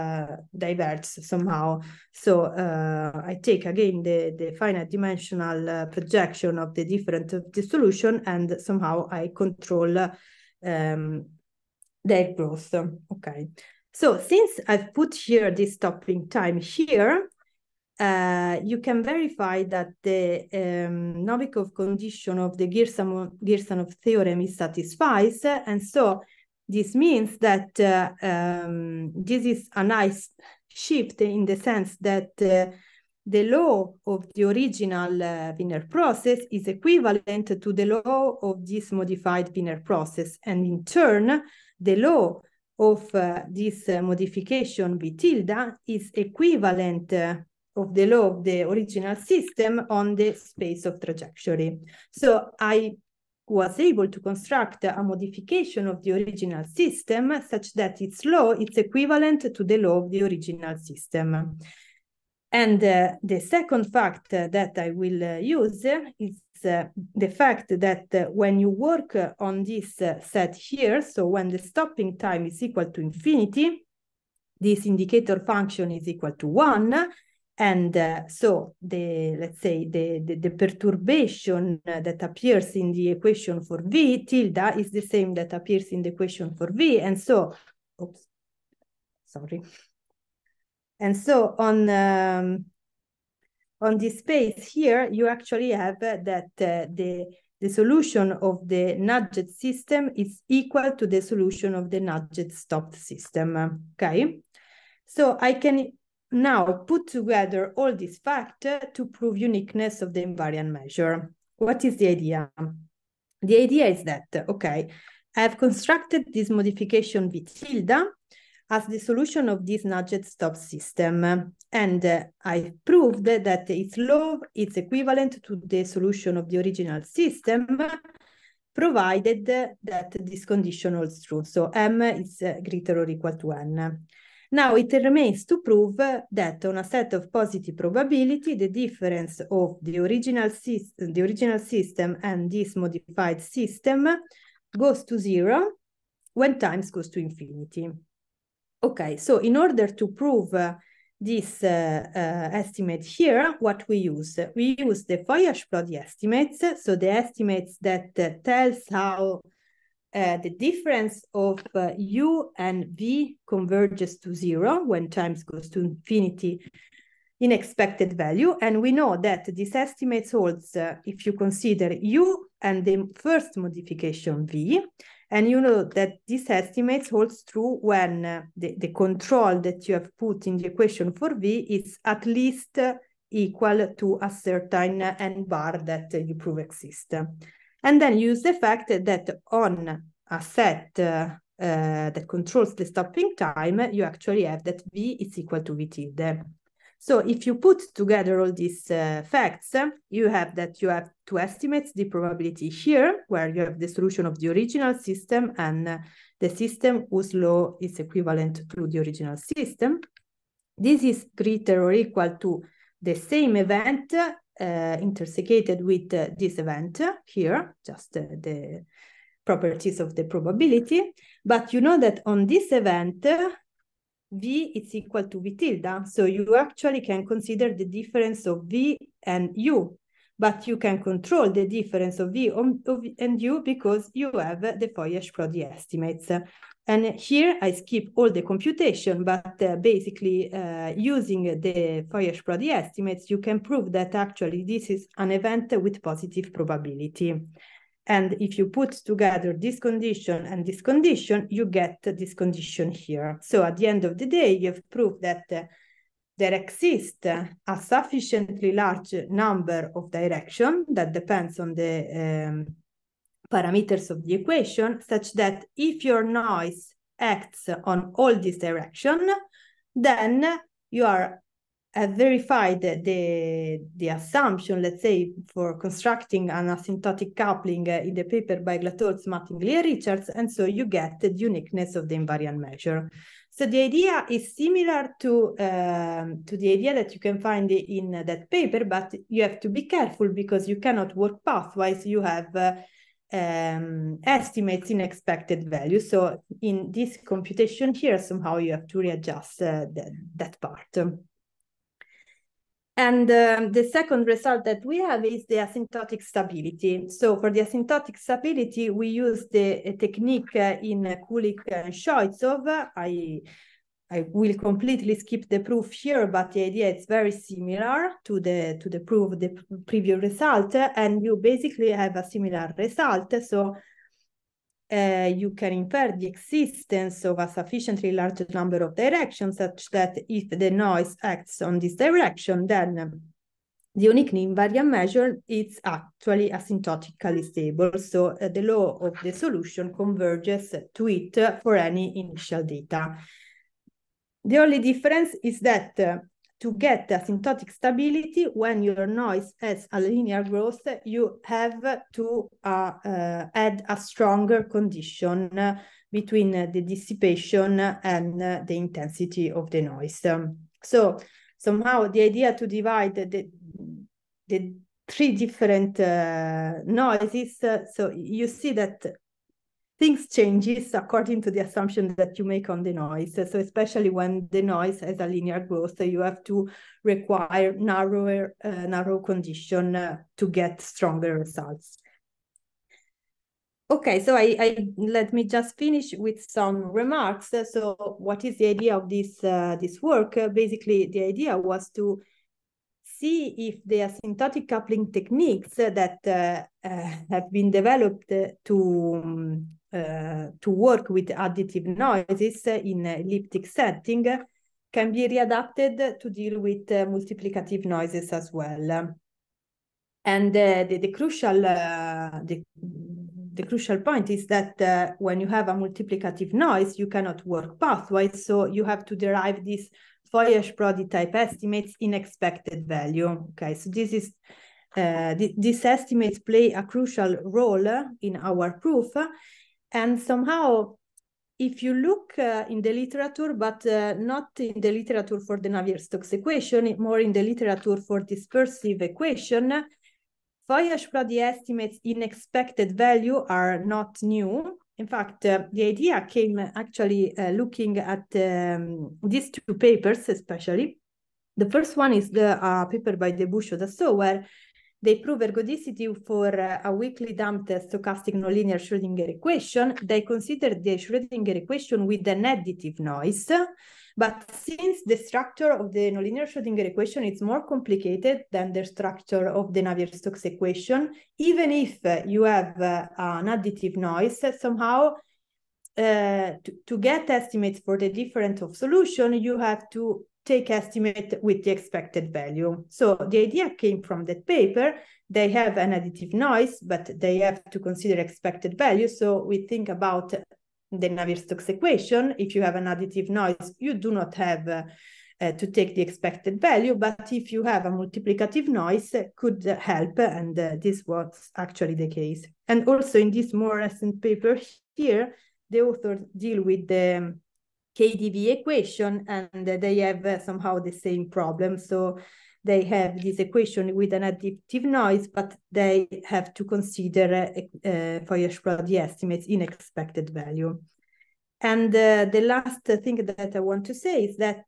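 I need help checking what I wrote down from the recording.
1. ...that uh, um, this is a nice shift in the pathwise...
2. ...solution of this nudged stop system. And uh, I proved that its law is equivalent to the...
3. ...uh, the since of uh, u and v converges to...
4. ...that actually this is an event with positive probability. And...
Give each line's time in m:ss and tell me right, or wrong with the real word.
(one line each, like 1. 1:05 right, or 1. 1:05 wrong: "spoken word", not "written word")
1. 0:27 wrong: "sense", not "pathwise"
2. 1:58 right
3. 2:40 wrong: "difference", not "since"
4. 4:03 right.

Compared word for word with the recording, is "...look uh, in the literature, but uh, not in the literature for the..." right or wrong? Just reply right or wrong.
right.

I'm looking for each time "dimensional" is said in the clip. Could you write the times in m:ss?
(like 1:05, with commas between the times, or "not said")
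0:04.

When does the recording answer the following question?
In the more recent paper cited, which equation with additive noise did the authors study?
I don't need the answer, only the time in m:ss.
8:27.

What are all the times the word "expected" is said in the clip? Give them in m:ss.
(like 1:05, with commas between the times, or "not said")
2:47, 4:55, 7:02, 7:22, 8:01, 8:08, 8:16, 8:39.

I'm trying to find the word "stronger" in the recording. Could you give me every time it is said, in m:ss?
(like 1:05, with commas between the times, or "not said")
5:53, 6:20.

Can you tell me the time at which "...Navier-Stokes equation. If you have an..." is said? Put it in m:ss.
8:11.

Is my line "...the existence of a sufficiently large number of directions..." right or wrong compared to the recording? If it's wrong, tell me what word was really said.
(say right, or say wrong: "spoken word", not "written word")
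right.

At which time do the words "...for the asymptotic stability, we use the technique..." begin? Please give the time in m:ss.
5:07.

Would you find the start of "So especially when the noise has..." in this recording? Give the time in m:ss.
6:13.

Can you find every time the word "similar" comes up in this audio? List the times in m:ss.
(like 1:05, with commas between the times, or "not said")
4:44, 5:17, 5:22.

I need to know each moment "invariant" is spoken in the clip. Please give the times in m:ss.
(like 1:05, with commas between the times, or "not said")
1:50, 4:42, 5:34.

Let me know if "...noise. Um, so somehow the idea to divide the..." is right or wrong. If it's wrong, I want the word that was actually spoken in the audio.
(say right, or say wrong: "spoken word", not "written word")
right.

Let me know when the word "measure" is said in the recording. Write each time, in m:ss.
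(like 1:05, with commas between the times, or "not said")
1:50, 4:42, 5:34.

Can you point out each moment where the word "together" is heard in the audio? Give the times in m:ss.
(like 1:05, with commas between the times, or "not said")
1:47, 3:17, 4:09.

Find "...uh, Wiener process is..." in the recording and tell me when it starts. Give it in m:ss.
0:35.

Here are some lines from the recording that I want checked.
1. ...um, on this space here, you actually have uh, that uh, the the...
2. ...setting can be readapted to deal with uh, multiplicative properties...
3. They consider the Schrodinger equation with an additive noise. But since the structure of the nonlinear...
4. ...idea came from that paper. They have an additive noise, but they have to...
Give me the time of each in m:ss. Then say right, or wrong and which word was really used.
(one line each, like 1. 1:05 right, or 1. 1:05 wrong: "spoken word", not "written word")
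1. 1:31 right
2. 6:43 wrong: "noises", not "properties"
3. 7:40 right
4. 8:03 right.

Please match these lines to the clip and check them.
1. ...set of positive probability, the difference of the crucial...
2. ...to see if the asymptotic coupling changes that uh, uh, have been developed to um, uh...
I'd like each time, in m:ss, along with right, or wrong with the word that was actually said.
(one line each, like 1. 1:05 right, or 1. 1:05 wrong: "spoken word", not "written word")
1. 2:16 wrong: "original", not "crucial"
2. 6:31 wrong: "techniques", not "changes".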